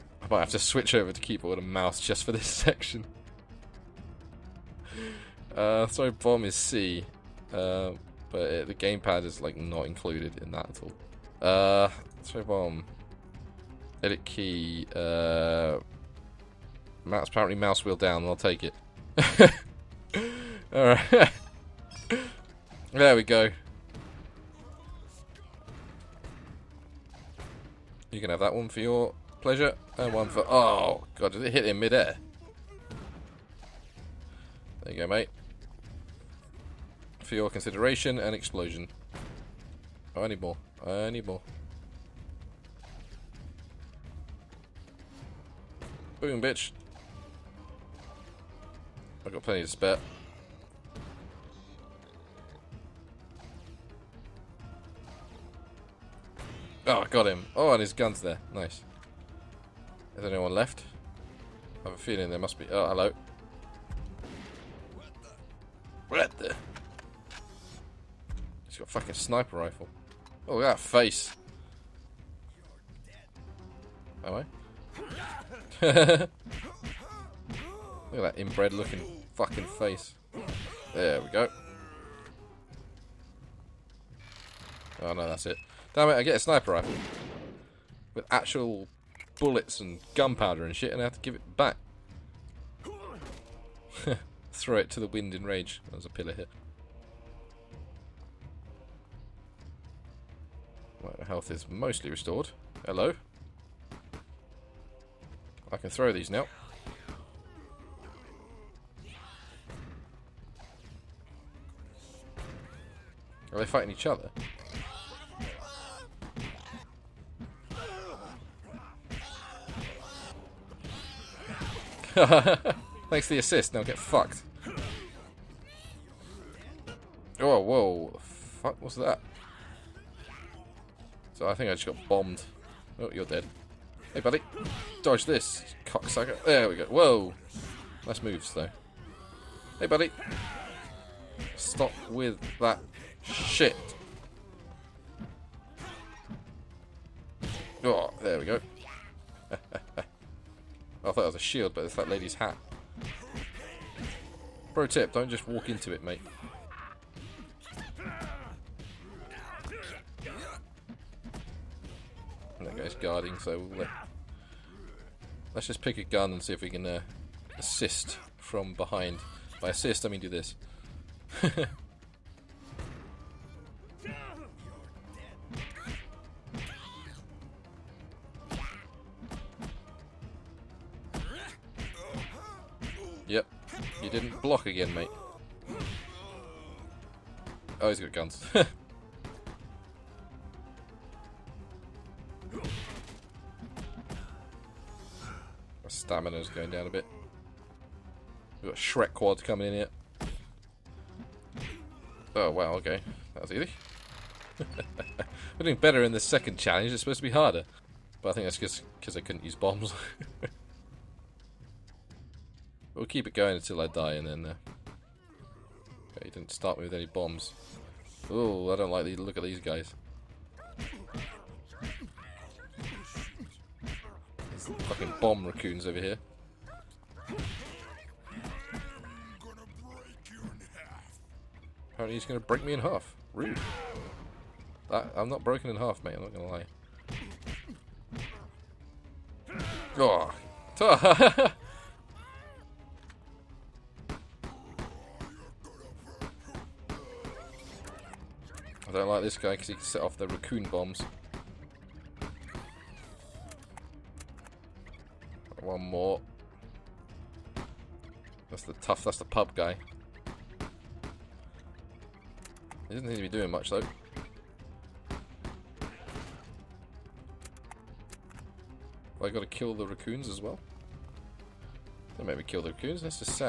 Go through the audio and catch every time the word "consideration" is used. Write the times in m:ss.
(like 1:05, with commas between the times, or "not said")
0:37.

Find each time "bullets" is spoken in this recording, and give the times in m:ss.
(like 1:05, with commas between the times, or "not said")
1:29.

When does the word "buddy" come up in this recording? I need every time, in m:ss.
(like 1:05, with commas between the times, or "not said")
2:14, 2:19.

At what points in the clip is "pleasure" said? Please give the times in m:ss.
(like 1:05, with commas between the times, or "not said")
0:29.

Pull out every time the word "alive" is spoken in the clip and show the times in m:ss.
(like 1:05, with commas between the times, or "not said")
not said.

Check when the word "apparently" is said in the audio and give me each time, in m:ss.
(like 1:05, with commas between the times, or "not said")
0:17, 3:51.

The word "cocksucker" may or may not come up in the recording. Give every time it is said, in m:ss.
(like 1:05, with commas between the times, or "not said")
2:15.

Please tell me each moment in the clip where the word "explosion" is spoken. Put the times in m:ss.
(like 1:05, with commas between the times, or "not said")
0:38.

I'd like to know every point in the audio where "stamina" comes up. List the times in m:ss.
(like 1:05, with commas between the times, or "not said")
3:15.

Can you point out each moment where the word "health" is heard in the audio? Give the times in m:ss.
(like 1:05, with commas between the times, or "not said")
1:41.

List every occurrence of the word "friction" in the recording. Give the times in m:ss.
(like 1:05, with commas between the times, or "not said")
not said.